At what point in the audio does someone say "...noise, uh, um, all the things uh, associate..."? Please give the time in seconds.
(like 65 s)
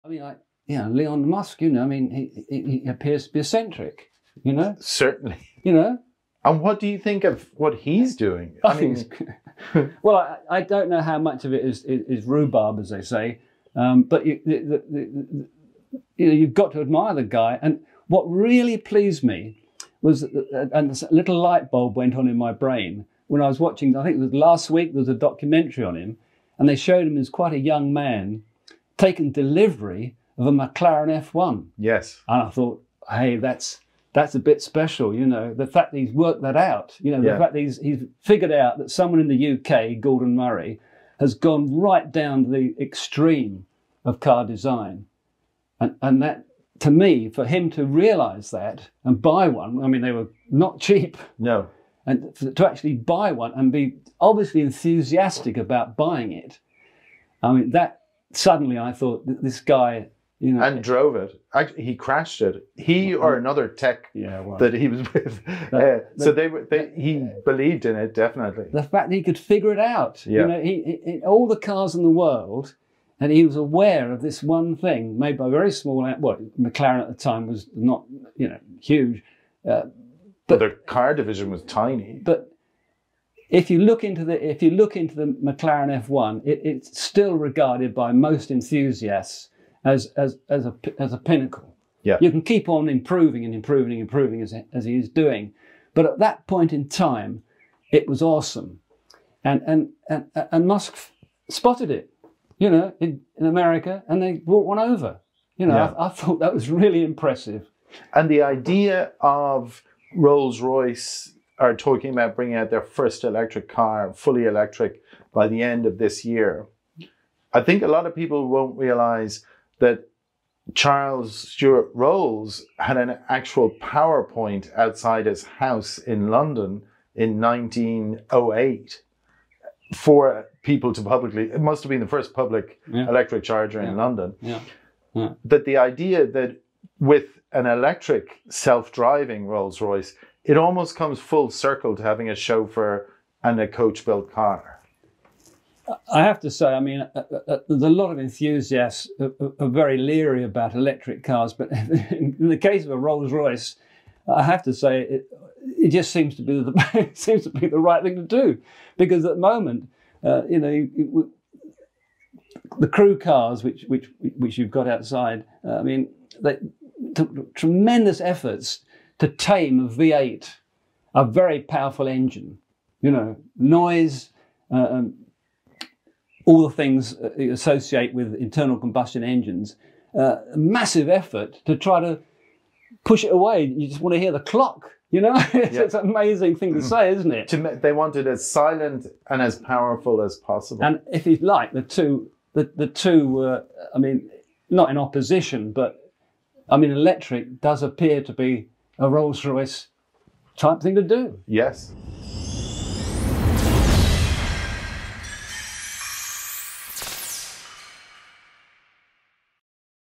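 173 s.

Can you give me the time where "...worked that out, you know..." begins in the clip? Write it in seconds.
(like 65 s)
36 s.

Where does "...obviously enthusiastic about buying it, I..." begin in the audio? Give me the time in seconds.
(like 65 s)
54 s.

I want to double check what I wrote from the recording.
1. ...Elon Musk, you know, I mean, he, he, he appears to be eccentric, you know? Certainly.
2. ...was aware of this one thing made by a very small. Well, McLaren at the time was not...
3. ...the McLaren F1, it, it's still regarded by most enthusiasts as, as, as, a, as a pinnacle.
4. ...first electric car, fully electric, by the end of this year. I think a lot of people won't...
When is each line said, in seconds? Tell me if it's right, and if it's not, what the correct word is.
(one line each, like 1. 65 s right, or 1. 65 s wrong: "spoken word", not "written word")
1. 0 s right
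2. 73 s right
3. 85 s right
4. 112 s right.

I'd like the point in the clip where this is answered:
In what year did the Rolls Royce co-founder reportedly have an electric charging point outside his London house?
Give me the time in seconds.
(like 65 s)
127 s.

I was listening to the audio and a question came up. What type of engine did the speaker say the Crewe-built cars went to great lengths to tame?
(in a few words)
V8.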